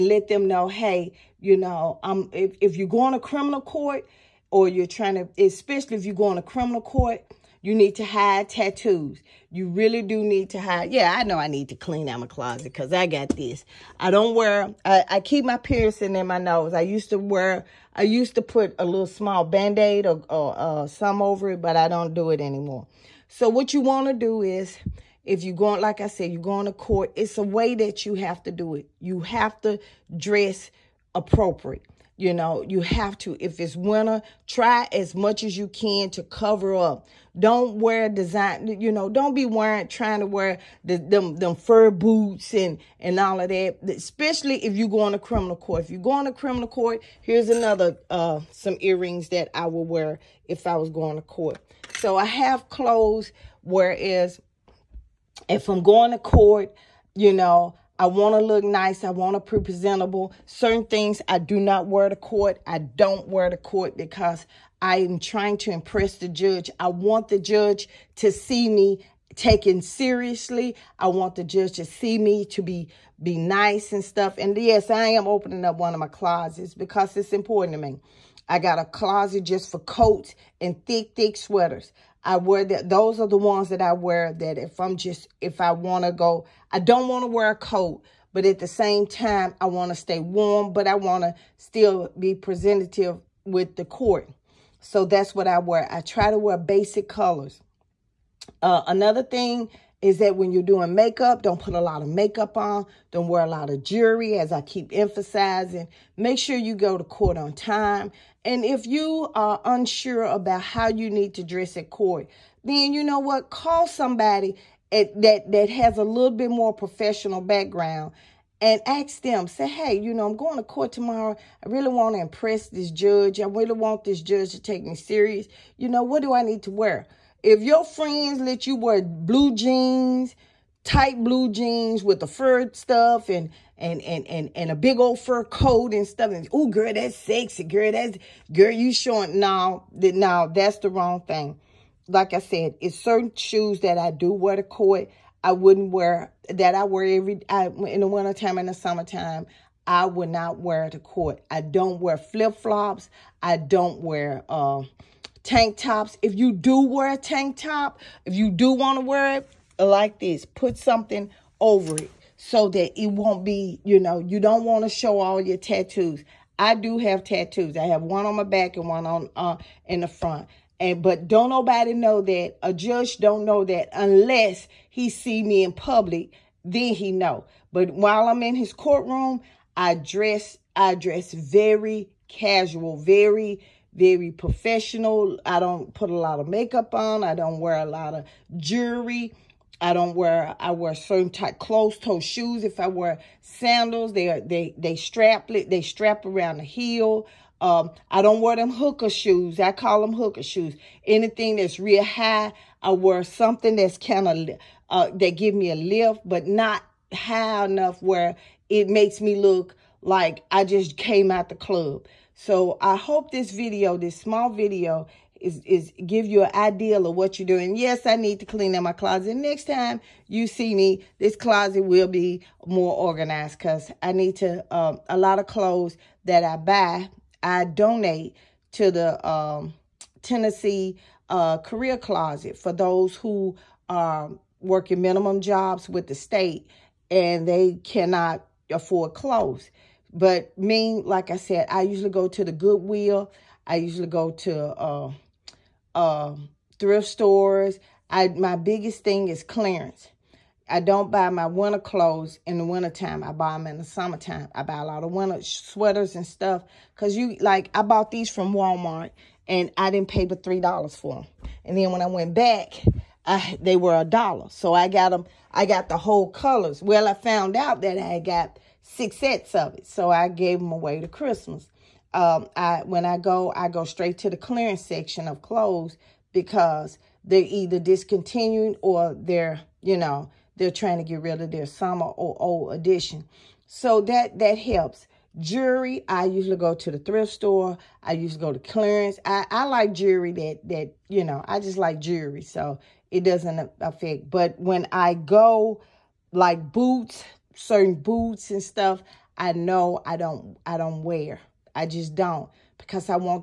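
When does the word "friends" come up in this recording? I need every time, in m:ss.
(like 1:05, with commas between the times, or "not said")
2:07.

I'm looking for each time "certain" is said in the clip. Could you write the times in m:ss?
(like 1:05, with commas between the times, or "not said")
1:00, 2:22, 3:10, 4:57.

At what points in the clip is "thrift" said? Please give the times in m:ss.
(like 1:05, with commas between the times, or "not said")
4:06, 4:46.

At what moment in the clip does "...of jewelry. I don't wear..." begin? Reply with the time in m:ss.
3:08.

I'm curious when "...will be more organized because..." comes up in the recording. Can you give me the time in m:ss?
3:41.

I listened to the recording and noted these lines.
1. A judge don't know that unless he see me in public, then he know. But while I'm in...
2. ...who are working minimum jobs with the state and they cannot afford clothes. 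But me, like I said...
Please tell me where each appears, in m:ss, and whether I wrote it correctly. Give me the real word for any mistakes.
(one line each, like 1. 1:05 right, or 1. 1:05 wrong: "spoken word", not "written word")
1. 2:52 right
2. 3:53 right.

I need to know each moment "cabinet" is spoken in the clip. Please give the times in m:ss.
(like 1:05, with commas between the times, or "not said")
not said.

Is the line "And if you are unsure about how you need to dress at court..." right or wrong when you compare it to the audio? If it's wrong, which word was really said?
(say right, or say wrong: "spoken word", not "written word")
right.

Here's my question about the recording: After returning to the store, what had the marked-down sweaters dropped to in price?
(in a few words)
$1.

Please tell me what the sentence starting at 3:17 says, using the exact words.
Um, I don't wear them hooker shoes.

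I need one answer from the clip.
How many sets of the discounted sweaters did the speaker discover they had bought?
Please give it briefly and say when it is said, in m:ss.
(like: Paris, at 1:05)
6, at 4:28.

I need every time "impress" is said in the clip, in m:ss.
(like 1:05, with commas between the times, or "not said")
1:05, 2:02.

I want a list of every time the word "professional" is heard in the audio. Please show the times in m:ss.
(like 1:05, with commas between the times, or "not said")
1:56, 3:04.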